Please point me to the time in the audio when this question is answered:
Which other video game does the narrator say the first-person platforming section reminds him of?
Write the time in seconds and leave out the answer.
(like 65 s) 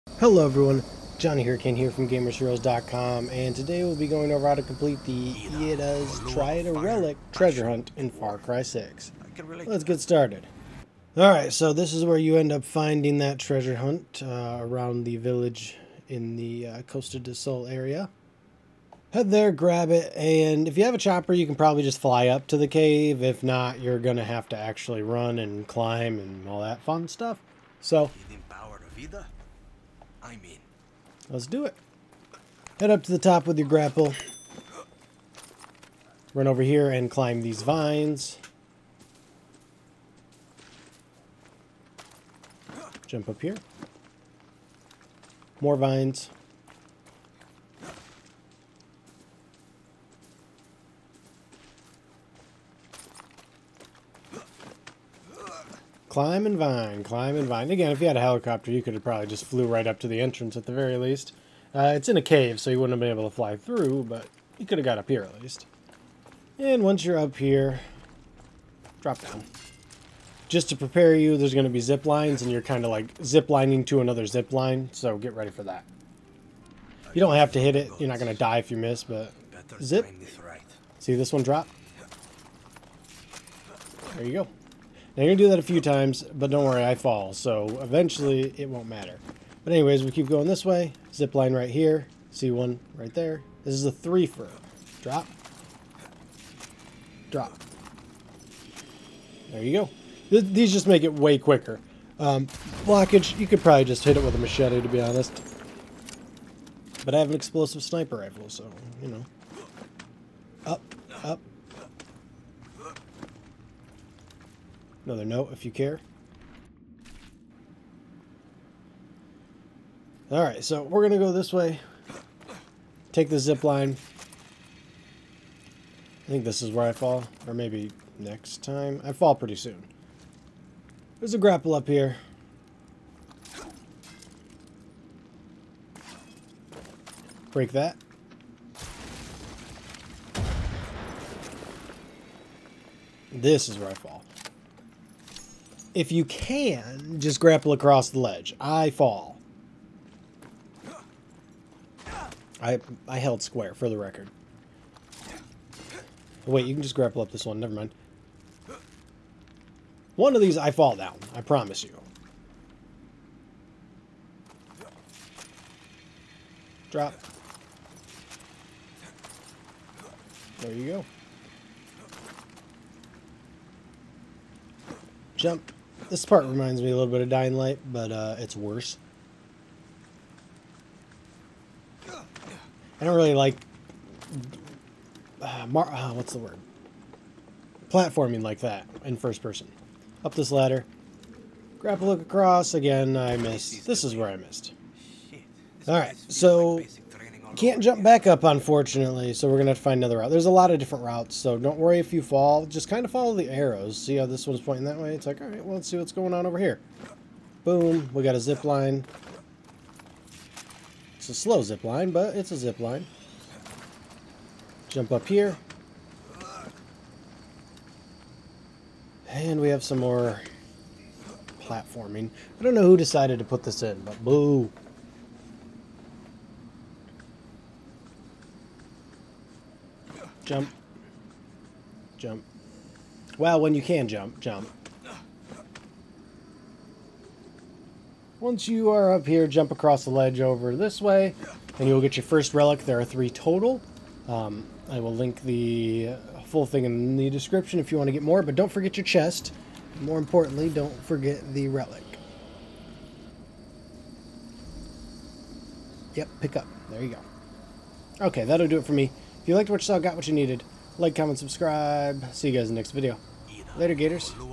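177 s.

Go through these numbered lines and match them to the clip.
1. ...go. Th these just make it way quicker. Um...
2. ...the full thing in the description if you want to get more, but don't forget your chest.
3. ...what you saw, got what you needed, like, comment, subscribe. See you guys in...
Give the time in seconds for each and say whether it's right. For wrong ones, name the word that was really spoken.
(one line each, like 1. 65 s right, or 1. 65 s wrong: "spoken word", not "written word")
1. 99 s right
2. 245 s right
3. 259 s right.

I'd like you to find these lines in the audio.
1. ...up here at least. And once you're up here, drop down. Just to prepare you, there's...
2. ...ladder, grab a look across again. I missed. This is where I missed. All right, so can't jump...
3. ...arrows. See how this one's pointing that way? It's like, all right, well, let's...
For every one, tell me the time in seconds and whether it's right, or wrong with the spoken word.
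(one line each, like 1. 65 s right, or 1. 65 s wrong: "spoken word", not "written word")
1. 64 s right
2. 190 s right
3. 203 s right.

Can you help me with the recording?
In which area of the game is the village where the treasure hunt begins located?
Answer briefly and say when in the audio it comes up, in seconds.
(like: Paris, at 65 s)
Costa de Sol, at 16 s.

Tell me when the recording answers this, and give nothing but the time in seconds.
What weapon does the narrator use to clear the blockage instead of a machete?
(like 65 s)
107 s.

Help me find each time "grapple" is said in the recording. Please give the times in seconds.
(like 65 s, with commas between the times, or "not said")
33 s, 131 s, 147 s, 156 s.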